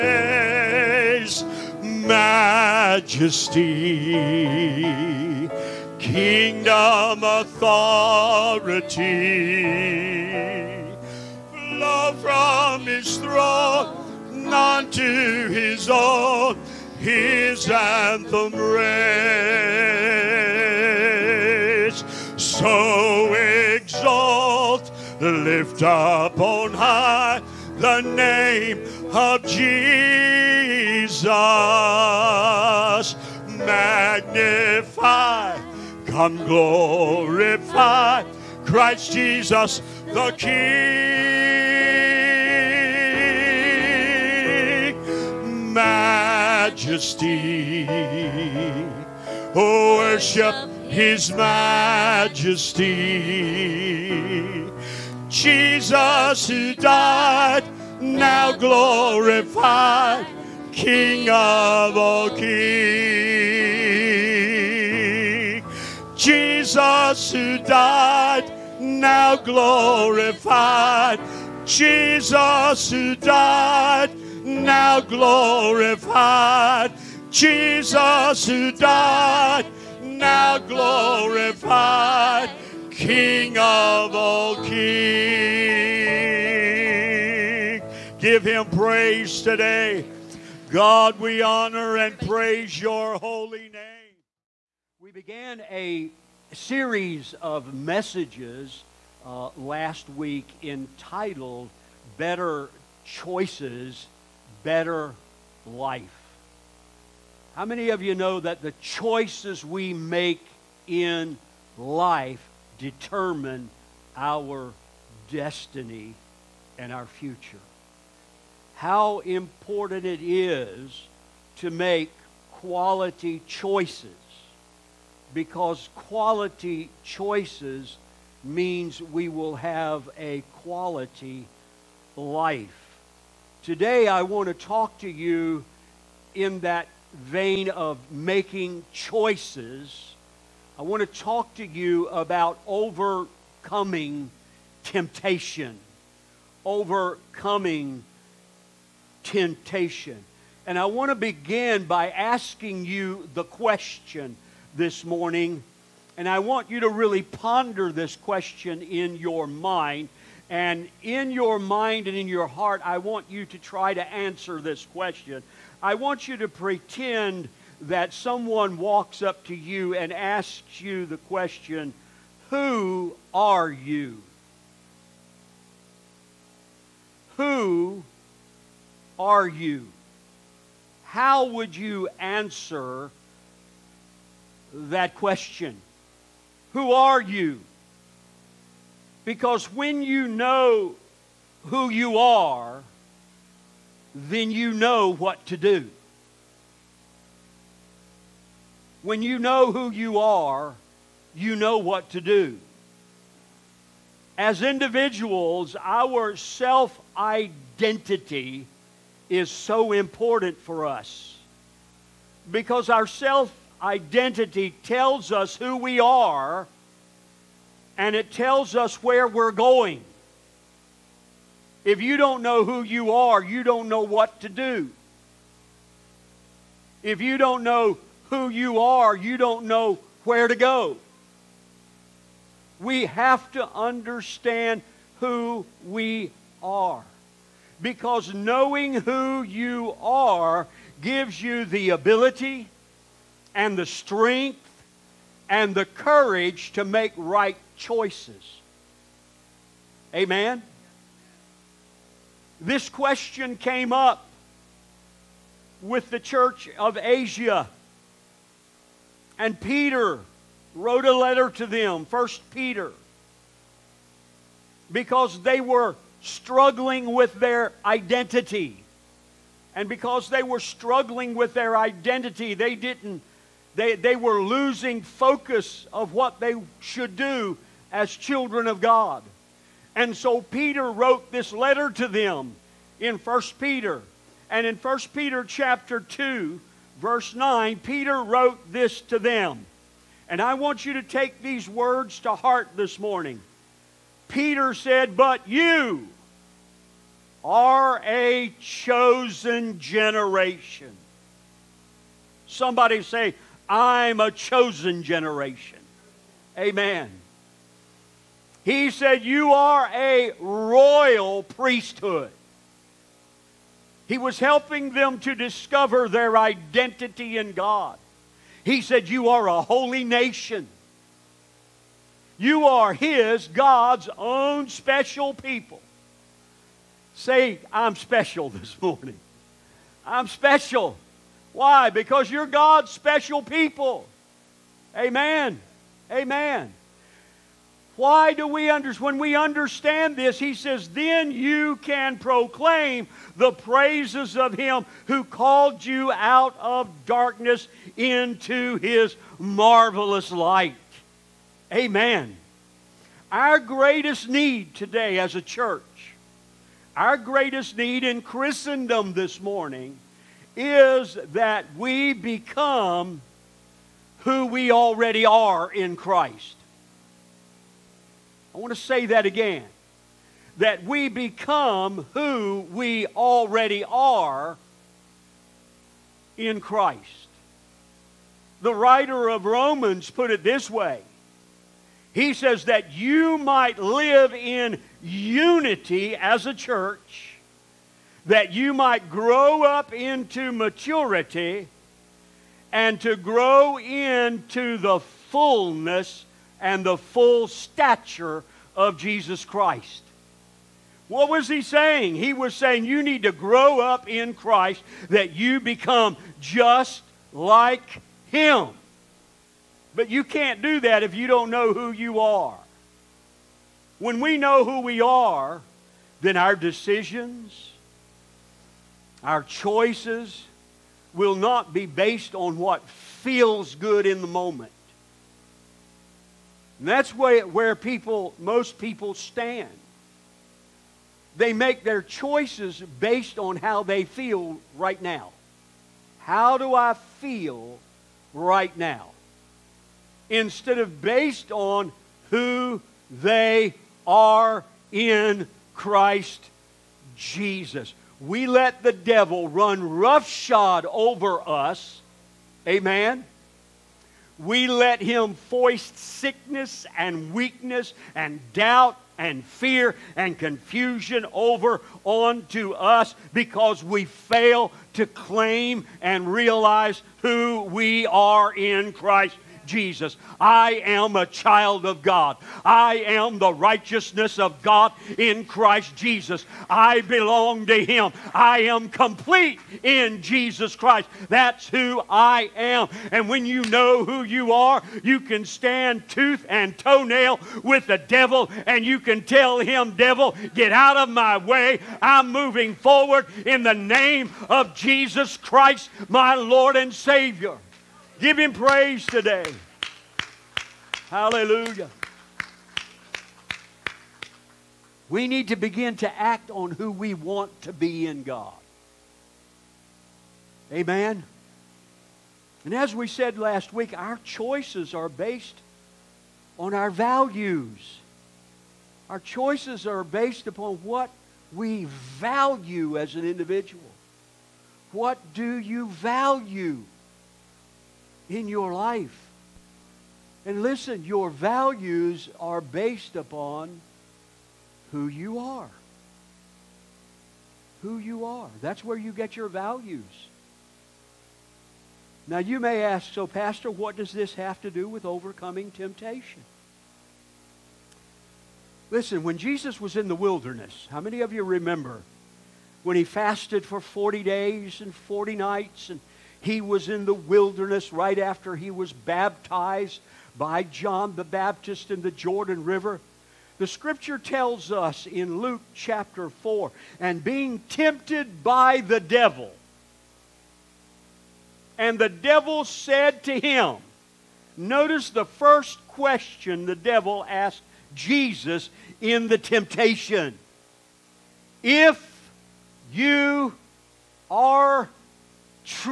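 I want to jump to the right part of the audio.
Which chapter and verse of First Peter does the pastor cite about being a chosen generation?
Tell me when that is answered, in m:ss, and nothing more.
4:45.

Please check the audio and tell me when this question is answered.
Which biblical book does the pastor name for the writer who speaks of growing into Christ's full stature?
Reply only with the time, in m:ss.
6:19.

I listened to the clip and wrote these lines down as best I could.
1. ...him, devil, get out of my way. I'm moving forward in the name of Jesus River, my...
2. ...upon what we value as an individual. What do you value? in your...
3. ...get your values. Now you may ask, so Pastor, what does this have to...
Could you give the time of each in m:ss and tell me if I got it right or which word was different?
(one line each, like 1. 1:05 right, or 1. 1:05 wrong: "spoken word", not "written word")
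1. 8:09 wrong: "Christ", not "River"
2. 8:40 right
3. 8:59 right.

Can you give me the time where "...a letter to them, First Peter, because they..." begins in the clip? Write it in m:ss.
4:21.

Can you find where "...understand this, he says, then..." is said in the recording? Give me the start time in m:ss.
5:39.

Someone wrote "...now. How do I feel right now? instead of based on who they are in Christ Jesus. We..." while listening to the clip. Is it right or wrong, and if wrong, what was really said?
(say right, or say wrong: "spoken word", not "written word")
right.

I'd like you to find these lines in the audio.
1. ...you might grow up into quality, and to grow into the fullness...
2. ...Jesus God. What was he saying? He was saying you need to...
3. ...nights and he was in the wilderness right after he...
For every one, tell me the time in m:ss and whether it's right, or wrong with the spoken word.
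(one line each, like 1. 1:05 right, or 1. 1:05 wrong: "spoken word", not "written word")
1. 6:28 wrong: "maturity", not "quality"
2. 6:38 wrong: "Christ", not "God"
3. 9:15 right.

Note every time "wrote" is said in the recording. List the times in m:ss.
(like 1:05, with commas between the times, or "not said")
4:20, 4:40, 4:48.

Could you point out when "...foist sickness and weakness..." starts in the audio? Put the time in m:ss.
7:35.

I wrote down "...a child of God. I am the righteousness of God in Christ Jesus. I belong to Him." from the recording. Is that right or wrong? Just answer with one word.
right.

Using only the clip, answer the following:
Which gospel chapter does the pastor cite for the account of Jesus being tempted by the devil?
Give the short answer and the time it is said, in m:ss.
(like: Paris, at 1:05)
Luke chapter 4, at 9:25.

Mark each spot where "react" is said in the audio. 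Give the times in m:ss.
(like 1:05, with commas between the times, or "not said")
not said.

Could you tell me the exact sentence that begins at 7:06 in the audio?
And that's where, where people, most people stand.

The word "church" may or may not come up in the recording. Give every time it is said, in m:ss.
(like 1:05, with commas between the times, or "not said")
4:16, 5:55, 6:26.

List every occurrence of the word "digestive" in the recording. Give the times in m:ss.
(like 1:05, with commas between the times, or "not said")
not said.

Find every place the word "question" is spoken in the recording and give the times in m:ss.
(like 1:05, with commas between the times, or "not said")
2:33, 2:38, 2:44, 2:51, 3:05, 4:12, 9:35.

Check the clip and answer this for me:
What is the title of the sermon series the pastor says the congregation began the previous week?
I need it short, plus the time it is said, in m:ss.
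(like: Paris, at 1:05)
Better Choices, Better Life, at 1:42.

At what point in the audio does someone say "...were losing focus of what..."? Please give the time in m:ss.
4:34.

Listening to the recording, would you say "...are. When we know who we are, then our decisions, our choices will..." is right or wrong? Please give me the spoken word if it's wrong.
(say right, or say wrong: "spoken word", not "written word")
right.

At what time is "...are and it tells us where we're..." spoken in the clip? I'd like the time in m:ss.
3:36.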